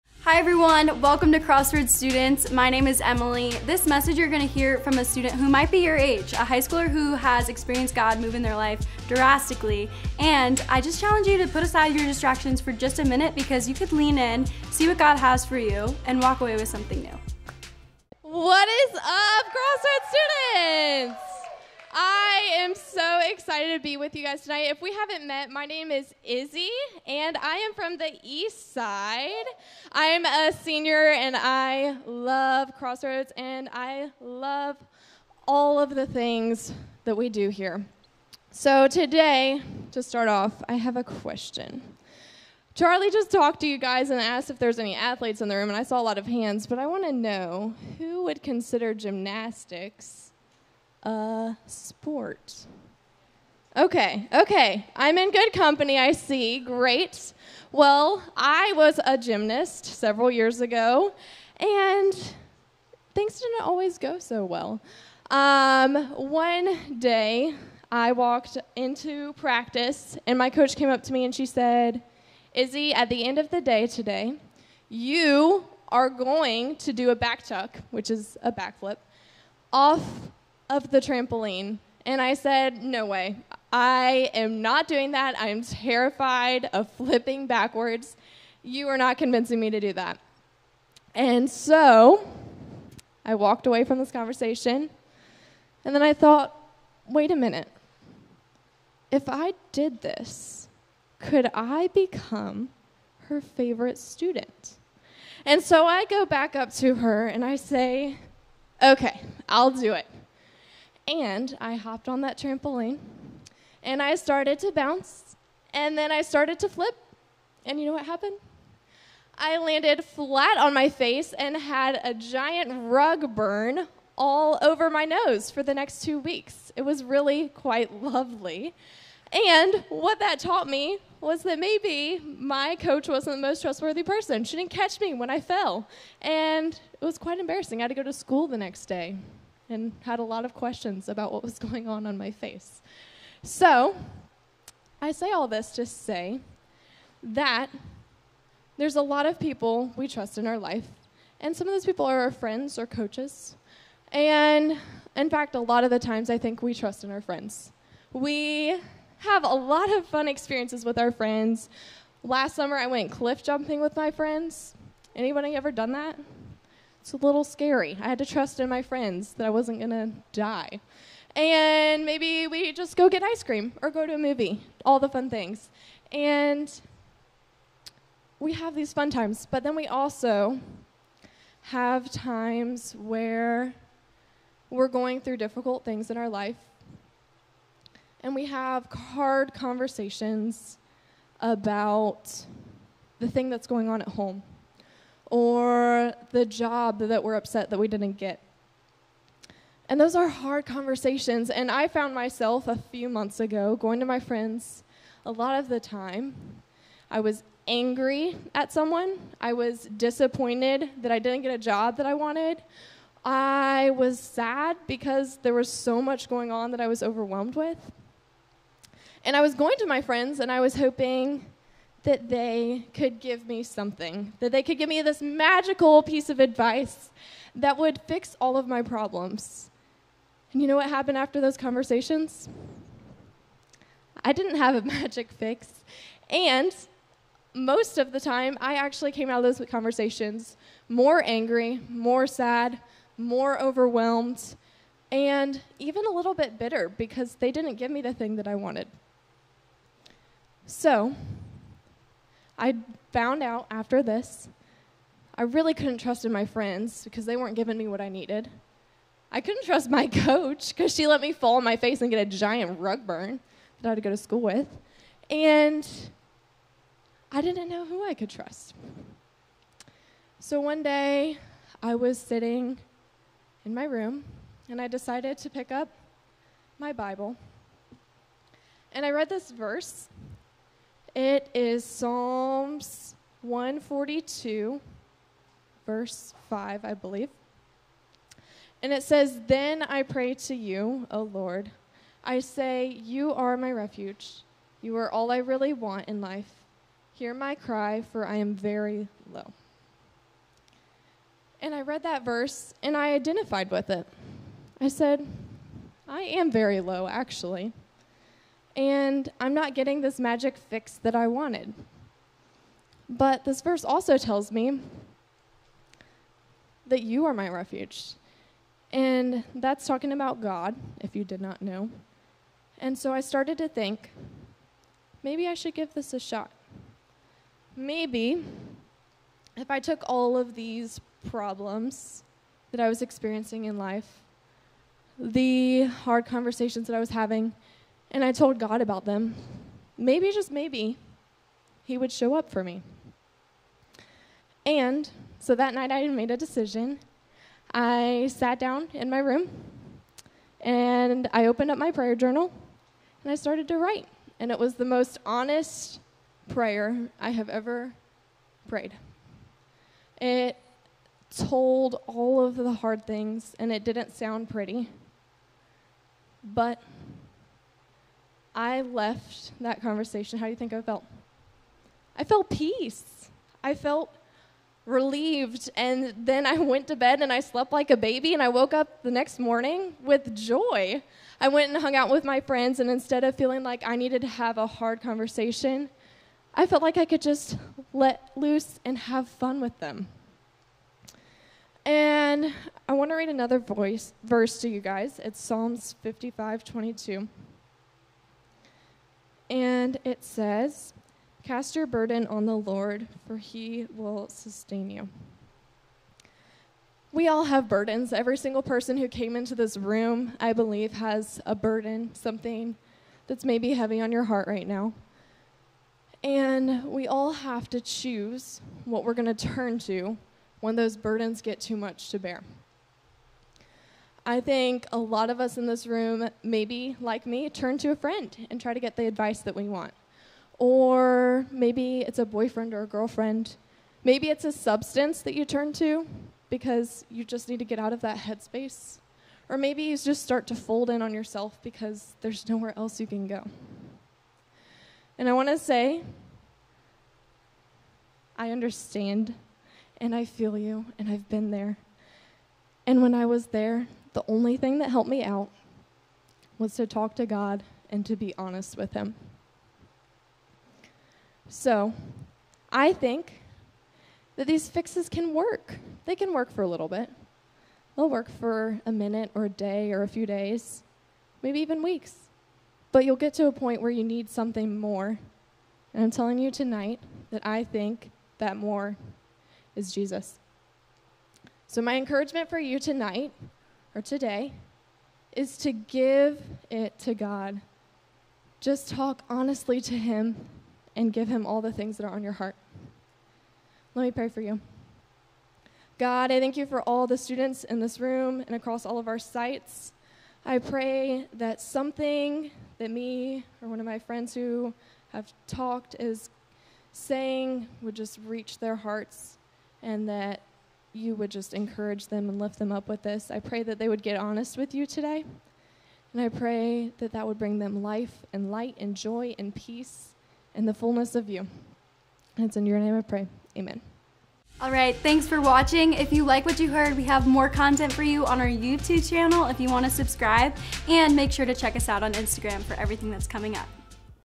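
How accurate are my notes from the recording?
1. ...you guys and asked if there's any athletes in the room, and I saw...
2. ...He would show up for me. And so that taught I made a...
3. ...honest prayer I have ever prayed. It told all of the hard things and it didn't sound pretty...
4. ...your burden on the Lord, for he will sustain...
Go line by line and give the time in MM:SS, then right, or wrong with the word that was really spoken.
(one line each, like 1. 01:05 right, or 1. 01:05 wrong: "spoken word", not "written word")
1. 00:43 right
2. 05:41 wrong: "night", not "taught"
3. 05:55 right
4. 06:41 right.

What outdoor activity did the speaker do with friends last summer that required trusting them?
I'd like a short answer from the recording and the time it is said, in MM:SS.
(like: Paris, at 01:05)
Cliff jumping, at 02:43.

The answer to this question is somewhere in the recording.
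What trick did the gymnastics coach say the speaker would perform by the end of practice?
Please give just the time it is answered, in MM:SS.
01:17.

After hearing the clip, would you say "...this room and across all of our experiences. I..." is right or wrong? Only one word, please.
wrong.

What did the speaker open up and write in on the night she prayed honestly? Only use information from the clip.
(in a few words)
Prayer journal.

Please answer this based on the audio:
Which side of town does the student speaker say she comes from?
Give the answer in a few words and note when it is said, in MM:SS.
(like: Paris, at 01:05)
East Side, at 00:28.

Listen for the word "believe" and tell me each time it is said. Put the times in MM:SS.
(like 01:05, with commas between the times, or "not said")
04:46, 06:50.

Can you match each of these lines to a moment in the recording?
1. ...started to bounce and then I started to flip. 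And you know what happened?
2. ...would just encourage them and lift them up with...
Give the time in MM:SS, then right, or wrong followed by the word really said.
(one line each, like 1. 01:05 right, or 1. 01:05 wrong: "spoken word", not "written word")
1. 01:54 right
2. 08:31 right.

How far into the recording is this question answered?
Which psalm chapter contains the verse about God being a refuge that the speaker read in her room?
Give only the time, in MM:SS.
04:43.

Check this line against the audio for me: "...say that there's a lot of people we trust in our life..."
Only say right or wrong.
right.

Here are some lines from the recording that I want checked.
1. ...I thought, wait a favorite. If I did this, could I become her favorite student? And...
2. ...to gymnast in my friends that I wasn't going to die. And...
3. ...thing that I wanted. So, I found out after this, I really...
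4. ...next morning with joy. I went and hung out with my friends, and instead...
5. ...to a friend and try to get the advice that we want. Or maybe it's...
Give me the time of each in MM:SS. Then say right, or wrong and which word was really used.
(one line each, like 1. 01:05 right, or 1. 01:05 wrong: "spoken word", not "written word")
1. 01:36 wrong: "minute", not "favorite"
2. 02:48 wrong: "trust", not "gymnast"
3. 04:08 right
4. 06:19 right
5. 07:07 right.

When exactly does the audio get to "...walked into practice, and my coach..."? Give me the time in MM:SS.
01:08.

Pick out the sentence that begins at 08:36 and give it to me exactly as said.
And I pray that that would bring them life and light and joy and peace and the fullness of you.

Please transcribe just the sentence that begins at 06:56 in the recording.
And we all have to choose what we're going to turn to when those burdens get too much to bear.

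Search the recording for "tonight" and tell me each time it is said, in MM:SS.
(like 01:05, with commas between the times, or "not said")
00:24, 07:56, 08:02.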